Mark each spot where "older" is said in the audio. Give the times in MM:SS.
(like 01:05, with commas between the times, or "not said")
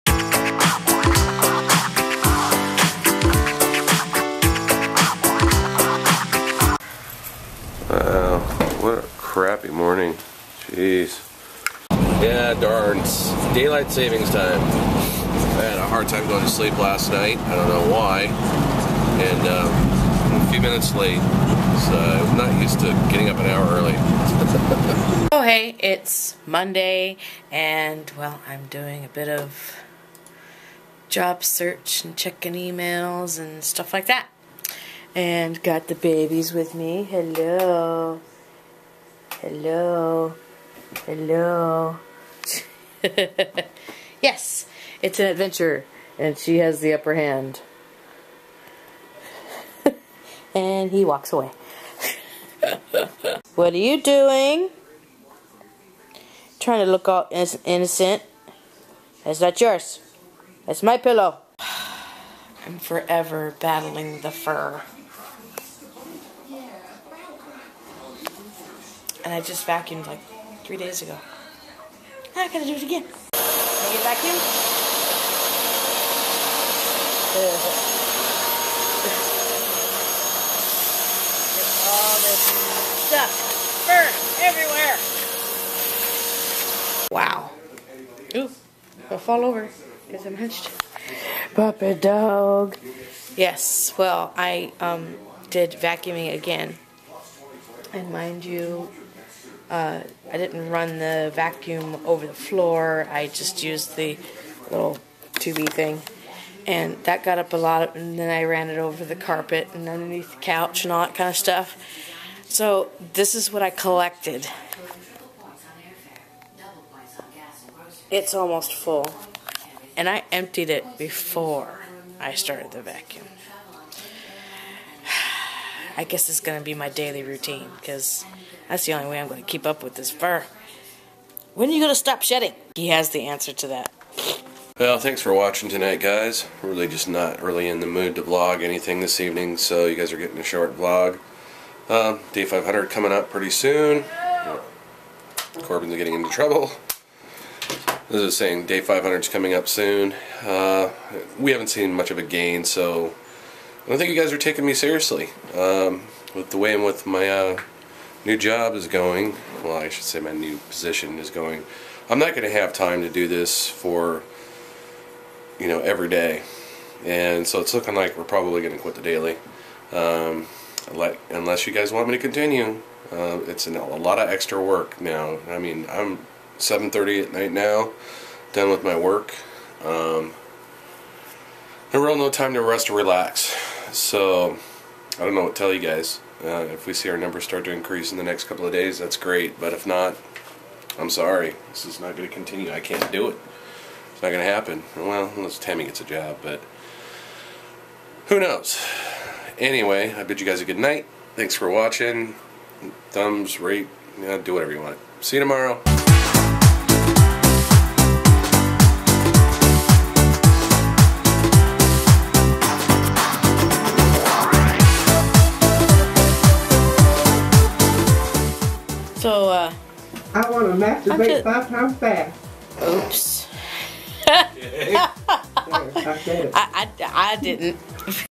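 not said.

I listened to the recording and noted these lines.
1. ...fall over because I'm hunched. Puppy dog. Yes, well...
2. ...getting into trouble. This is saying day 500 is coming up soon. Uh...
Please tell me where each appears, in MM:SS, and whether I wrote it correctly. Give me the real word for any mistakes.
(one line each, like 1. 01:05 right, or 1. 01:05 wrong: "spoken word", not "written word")
1. 01:29 right
2. 02:25 right.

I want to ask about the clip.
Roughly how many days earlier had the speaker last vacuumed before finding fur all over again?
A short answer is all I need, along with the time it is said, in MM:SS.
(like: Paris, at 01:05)
3 days, at 01:10.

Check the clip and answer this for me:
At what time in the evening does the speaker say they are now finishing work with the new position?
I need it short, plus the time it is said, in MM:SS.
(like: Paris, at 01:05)
7:30, at 02:56.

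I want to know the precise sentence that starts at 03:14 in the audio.
Well, unless Tammie gets a job, but who knows?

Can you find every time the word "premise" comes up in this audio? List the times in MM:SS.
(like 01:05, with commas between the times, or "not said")
not said.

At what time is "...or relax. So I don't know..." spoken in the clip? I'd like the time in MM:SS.
03:02.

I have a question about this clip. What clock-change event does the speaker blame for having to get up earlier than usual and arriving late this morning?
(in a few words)
Daylight savings time.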